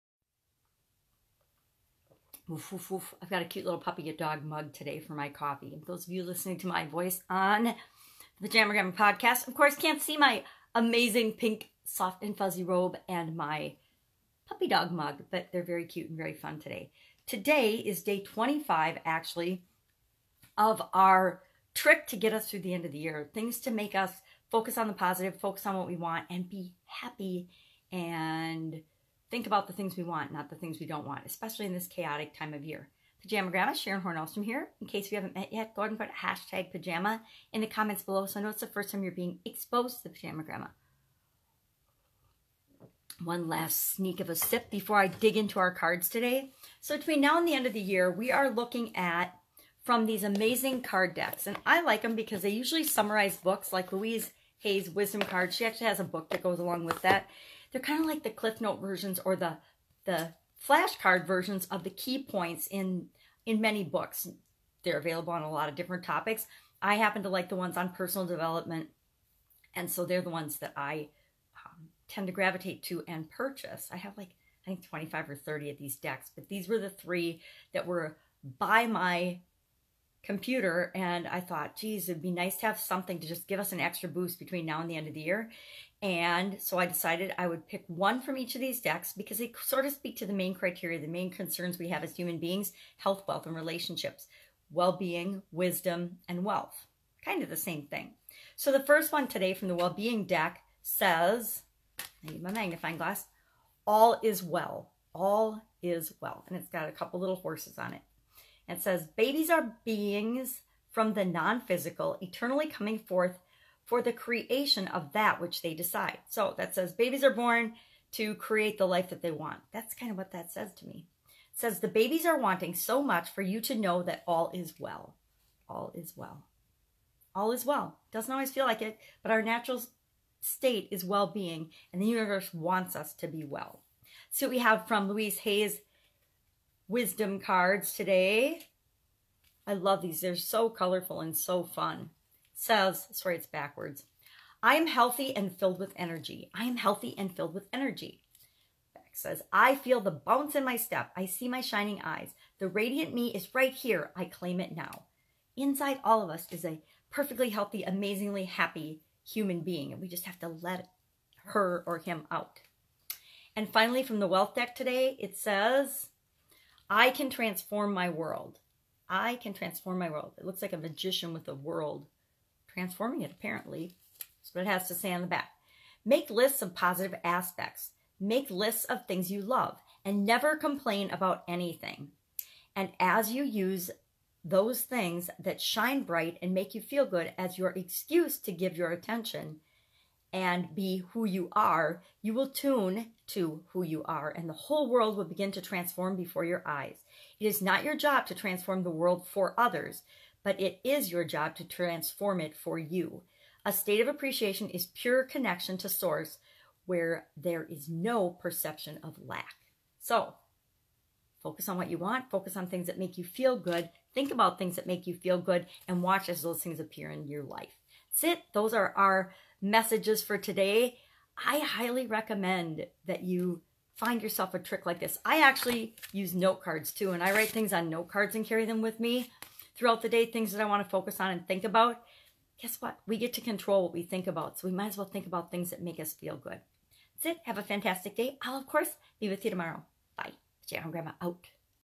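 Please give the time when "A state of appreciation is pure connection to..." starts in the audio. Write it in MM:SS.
03:23.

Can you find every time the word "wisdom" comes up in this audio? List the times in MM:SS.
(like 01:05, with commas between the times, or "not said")
00:54, 01:35, 02:16.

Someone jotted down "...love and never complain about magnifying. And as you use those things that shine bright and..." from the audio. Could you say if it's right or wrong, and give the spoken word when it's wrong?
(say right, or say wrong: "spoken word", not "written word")
wrong: "anything", not "magnifying".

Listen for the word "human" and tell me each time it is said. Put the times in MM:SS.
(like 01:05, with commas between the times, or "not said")
01:32, 02:39.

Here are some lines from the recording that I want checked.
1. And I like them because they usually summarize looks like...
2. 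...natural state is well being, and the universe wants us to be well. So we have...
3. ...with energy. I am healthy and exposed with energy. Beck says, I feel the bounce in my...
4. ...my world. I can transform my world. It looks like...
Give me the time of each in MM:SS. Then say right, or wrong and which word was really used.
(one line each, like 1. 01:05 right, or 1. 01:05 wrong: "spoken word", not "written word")
1. 00:51 wrong: "books", not "looks"
2. 02:09 right
3. 02:25 wrong: "filled", not "exposed"
4. 02:47 right.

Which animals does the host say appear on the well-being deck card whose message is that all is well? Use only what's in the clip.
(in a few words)
horses.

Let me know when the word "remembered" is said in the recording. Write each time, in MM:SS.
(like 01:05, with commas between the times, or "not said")
not said.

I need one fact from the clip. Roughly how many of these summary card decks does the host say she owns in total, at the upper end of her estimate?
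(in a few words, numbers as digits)
30.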